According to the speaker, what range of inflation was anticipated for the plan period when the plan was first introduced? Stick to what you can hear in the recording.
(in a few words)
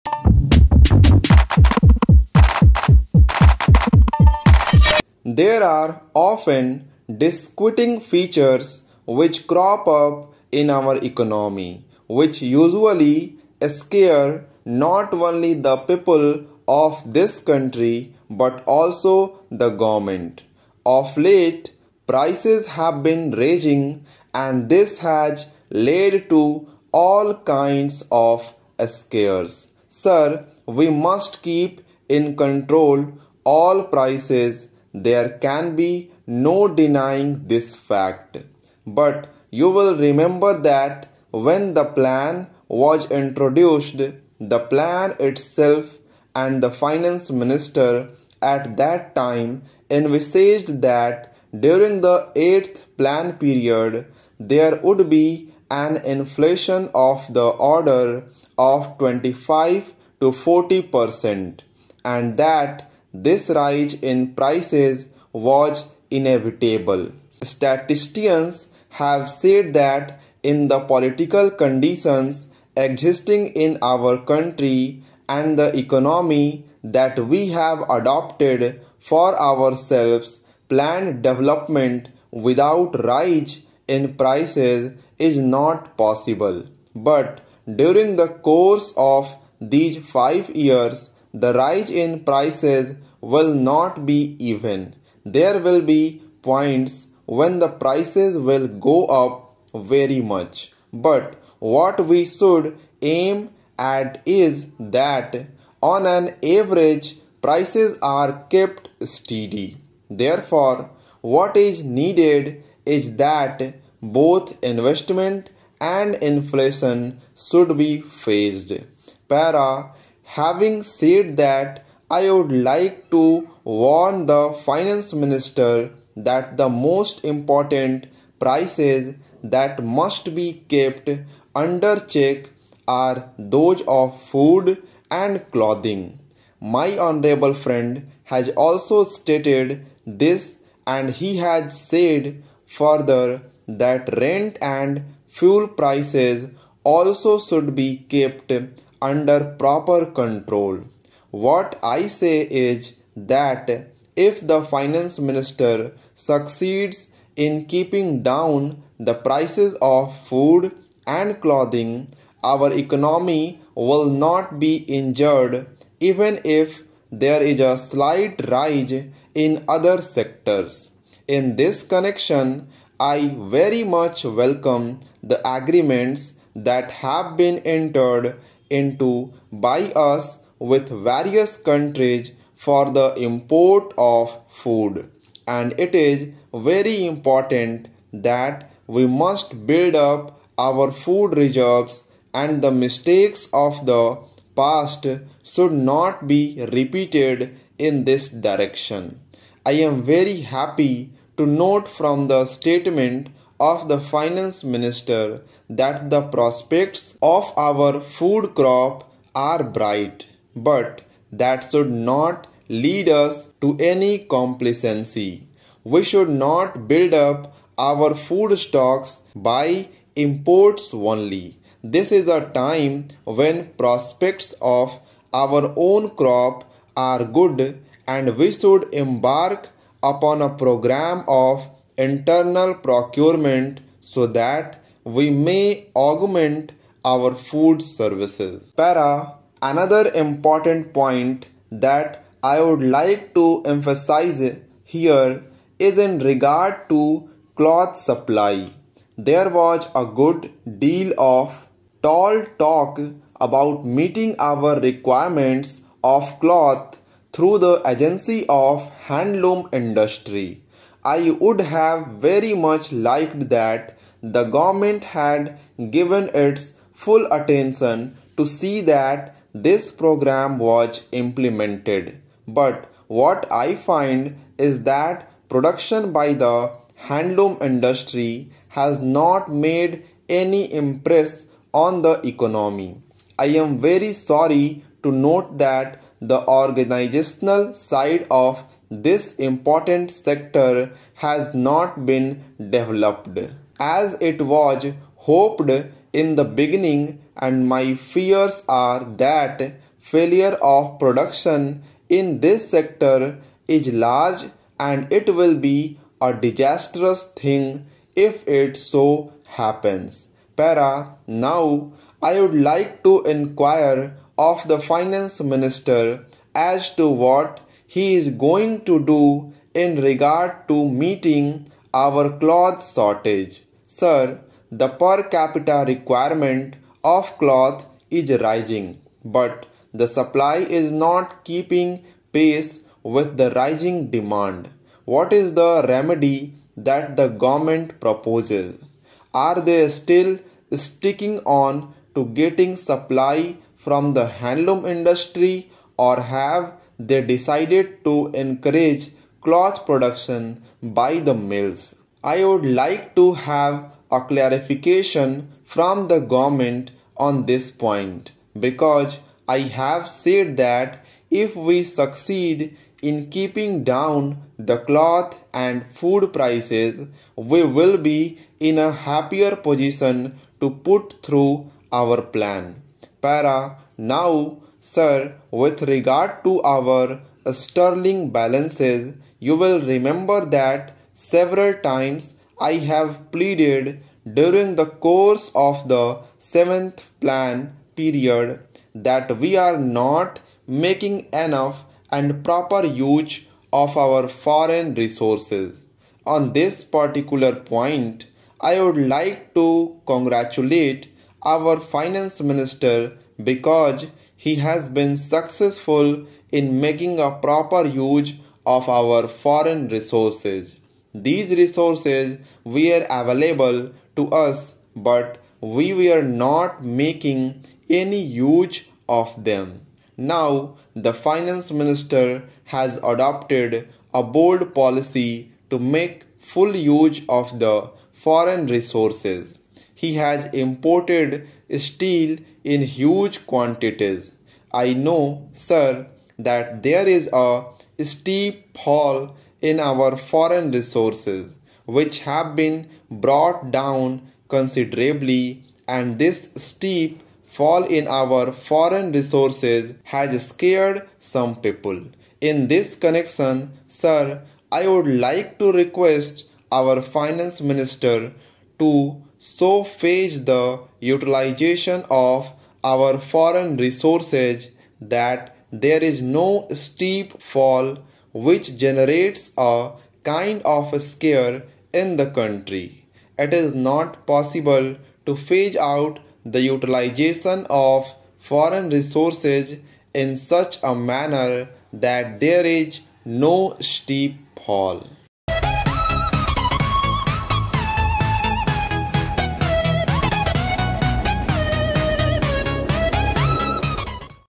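25 to 40 percent.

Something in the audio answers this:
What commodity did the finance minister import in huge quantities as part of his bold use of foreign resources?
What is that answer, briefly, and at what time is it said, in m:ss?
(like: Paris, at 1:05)
steel, at 7:11.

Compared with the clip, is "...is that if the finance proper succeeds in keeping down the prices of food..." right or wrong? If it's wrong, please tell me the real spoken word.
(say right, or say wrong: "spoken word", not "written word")
wrong: "minister", not "proper".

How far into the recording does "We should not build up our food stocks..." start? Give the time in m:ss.
3:35.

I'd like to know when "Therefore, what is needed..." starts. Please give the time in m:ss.
1:50.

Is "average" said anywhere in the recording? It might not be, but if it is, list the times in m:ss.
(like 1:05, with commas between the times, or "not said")
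1:46.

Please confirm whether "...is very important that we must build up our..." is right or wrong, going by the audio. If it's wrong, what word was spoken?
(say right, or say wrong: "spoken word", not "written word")
right.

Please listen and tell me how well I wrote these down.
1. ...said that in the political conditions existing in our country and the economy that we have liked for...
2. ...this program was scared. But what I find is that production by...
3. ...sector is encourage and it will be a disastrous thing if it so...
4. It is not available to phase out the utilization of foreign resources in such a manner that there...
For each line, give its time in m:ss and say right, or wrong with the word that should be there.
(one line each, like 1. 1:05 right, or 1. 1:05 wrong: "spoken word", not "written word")
1. 1:09 wrong: "adopted", not "liked"
2. 4:29 wrong: "implemented", not "scared"
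3. 5:02 wrong: "large", not "encourage"
4. 7:53 wrong: "possible", not "available".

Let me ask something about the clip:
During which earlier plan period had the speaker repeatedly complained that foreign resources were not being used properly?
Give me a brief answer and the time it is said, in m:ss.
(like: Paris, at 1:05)
seventh plan, at 6:26.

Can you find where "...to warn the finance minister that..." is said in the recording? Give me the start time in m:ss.
2:03.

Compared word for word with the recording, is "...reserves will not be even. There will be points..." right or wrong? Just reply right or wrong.
wrong.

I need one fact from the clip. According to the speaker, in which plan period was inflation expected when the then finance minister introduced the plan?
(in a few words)
8th plan.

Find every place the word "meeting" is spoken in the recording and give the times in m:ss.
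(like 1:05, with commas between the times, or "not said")
4:13, 5:21.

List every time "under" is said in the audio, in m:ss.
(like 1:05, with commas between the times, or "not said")
2:11, 2:29.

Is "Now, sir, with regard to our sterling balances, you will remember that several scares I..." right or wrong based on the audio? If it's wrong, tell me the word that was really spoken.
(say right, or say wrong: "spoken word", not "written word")
wrong: "times", not "scares".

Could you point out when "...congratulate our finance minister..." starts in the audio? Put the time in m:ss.
6:40.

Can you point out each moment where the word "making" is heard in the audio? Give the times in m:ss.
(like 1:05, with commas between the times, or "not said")
6:30, 6:46, 6:56.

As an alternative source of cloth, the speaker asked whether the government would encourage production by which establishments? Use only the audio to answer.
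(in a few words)
mills.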